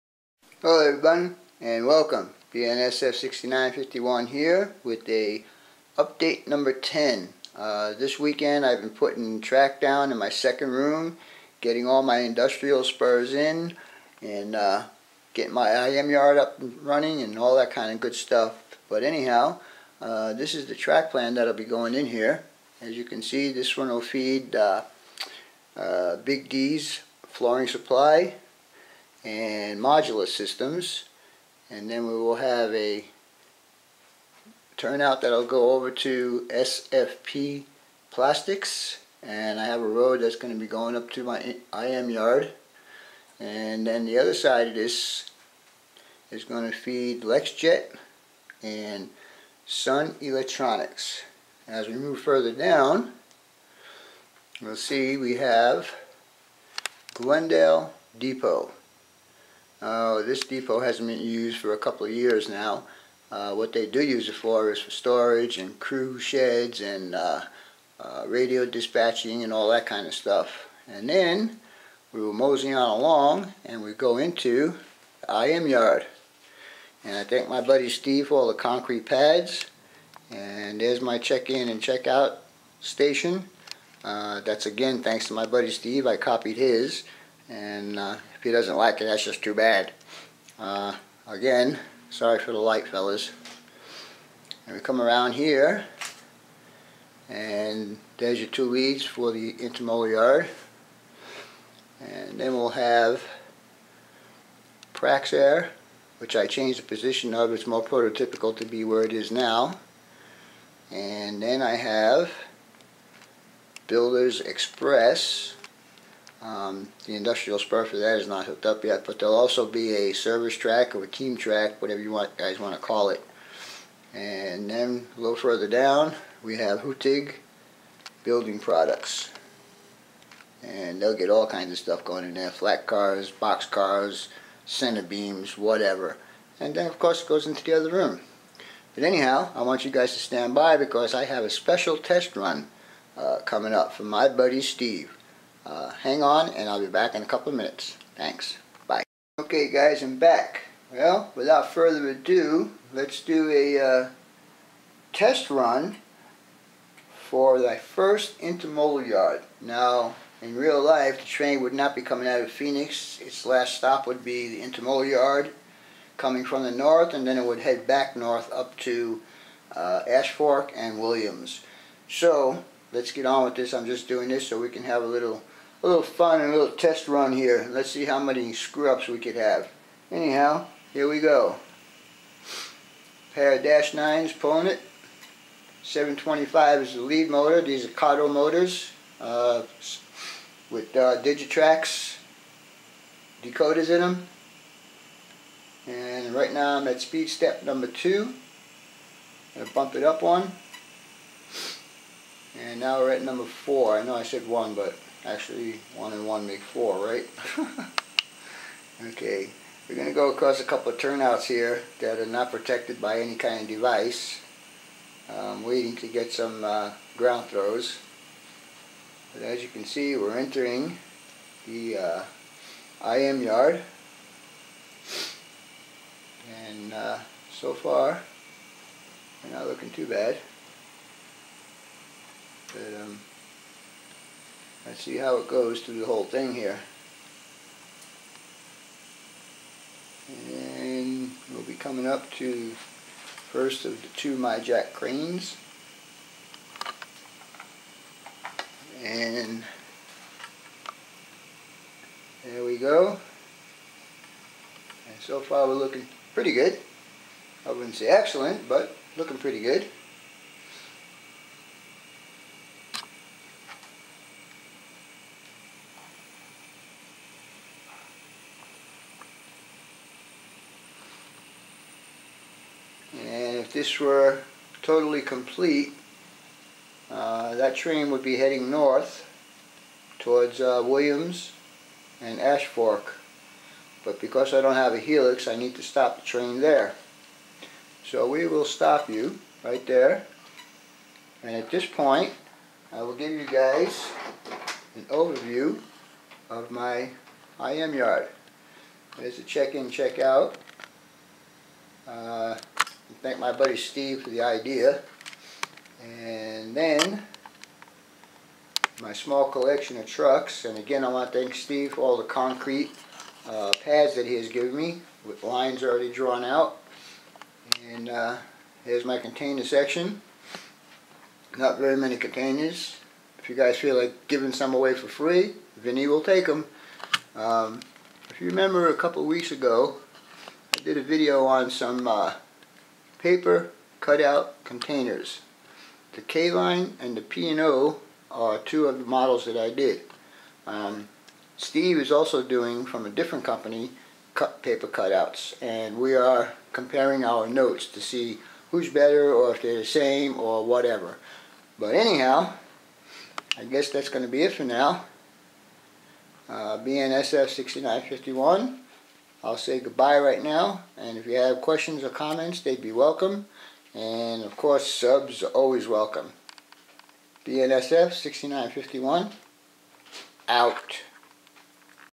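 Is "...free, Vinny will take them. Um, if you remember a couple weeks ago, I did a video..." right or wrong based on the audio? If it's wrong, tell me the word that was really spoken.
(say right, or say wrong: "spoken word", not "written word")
right.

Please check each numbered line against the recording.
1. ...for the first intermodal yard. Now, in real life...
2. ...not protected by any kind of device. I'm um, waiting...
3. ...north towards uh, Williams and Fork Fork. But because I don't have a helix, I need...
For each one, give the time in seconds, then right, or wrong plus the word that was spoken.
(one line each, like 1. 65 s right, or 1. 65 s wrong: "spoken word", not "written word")
1. 157 s right
2. 212 s right
3. 278 s wrong: "Ash", not "Fork".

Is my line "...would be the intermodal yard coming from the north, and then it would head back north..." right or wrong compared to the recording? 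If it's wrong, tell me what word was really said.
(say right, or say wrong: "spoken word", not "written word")
right.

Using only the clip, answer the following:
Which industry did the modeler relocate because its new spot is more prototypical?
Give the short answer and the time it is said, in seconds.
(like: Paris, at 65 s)
Praxair, at 104 s.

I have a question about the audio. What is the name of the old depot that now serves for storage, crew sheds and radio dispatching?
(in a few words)
Glendale Depot.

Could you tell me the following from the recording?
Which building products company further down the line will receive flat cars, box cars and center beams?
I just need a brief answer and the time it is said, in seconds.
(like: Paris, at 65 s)
Hutig Building Products, at 126 s.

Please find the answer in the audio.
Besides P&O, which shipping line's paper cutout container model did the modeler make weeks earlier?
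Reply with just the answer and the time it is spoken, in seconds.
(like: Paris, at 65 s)
K-Line, at 336 s.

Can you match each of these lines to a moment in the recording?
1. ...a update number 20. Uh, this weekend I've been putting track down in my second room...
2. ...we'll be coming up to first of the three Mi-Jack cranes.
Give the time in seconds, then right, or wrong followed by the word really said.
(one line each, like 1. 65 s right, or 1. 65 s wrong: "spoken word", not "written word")
1. 5 s wrong: "10", not "20"
2. 241 s wrong: "two", not "three".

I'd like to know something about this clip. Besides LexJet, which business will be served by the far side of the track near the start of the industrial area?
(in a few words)
Sun Electronics.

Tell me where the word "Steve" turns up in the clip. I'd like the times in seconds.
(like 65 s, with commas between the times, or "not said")
77 s, 85 s, 144 s, 303 s, 311 s, 341 s.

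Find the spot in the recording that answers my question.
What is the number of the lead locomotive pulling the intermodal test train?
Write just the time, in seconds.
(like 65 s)
185 s.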